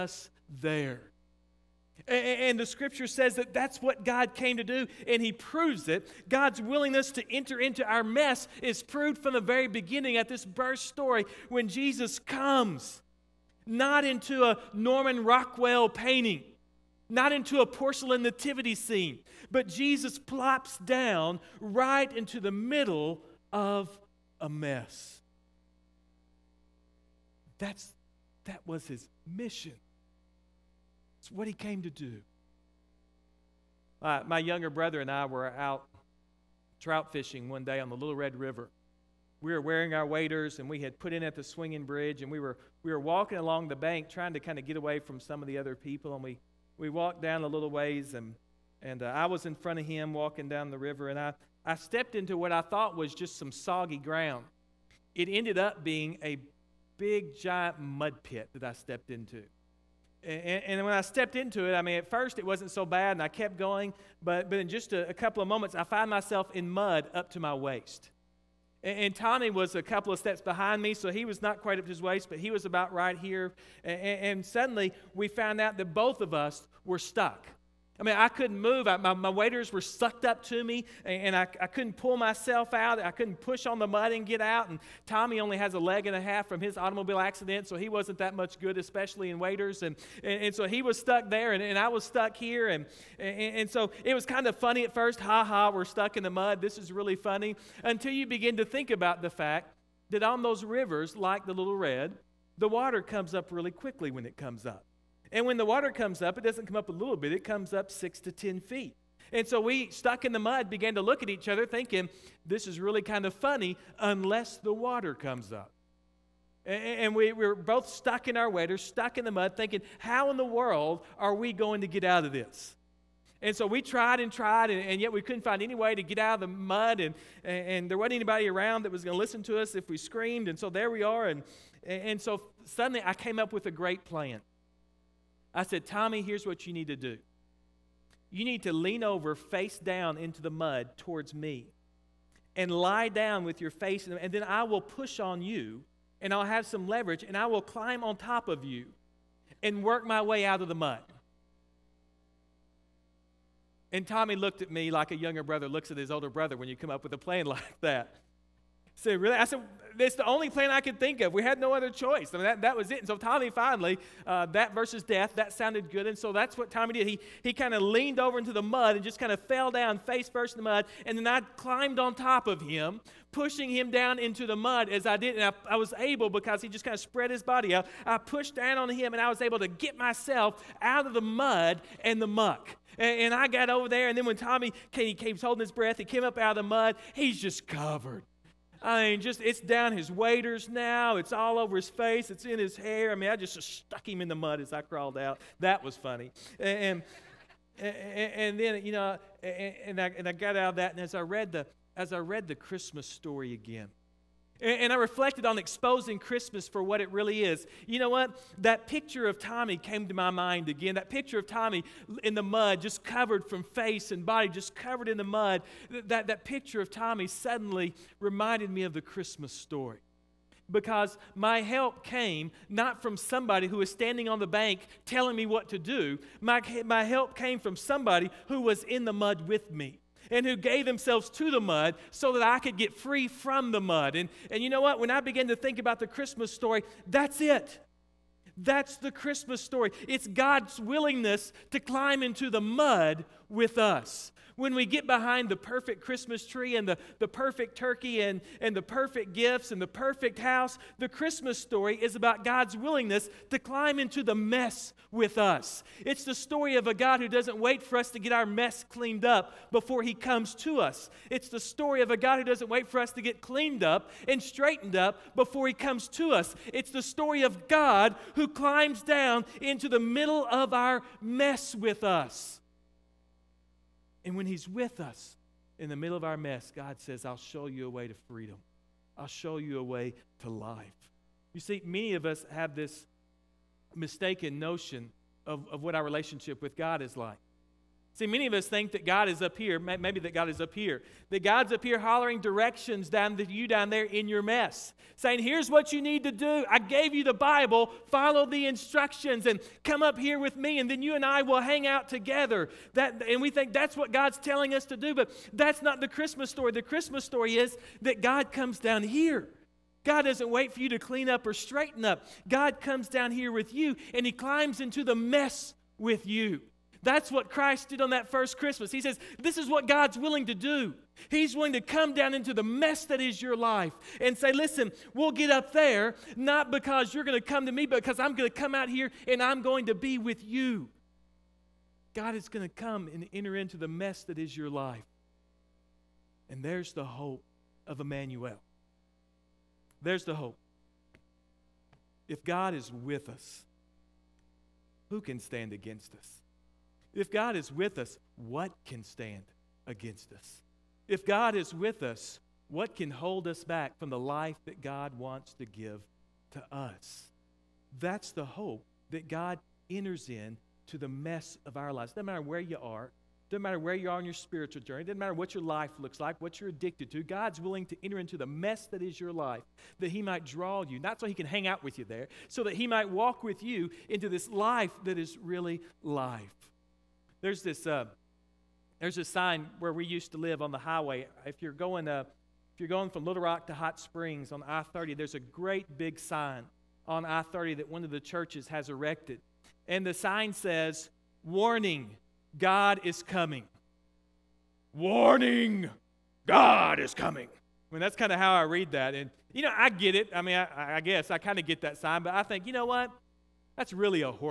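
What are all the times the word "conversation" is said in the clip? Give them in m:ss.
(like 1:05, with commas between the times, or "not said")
not said.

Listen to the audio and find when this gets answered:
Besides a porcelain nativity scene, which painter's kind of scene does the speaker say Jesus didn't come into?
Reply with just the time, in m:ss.
0:14.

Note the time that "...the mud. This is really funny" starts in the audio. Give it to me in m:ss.
1:36.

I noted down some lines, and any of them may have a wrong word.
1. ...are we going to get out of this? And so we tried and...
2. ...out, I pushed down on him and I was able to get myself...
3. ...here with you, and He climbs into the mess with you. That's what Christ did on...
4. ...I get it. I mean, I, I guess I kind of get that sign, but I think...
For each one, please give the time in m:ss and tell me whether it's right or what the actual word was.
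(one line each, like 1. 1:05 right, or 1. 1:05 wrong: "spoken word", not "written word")
1. 2:01 right
2. 2:57 right
3. 5:13 right
4. 6:39 right.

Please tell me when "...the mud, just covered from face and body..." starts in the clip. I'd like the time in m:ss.
3:32.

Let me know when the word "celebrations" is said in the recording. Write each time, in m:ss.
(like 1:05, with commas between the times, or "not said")
not said.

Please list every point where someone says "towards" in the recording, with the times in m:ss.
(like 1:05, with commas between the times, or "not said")
2:20.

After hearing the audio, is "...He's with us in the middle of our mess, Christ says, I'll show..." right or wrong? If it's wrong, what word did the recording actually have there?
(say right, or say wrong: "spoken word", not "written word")
wrong: "God", not "Christ".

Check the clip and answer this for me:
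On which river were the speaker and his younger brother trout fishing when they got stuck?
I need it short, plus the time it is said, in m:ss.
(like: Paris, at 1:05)
Little Red River, at 0:37.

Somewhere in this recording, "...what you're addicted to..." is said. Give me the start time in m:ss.
6:06.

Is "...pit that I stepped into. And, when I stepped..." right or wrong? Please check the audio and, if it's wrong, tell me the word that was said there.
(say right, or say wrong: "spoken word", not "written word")
right.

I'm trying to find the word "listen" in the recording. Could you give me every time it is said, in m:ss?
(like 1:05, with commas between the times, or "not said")
2:09, 5:24.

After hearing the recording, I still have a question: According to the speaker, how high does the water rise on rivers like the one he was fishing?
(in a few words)
6 to 10 feet.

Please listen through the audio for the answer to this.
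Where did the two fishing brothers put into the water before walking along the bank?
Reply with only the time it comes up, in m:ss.
0:41.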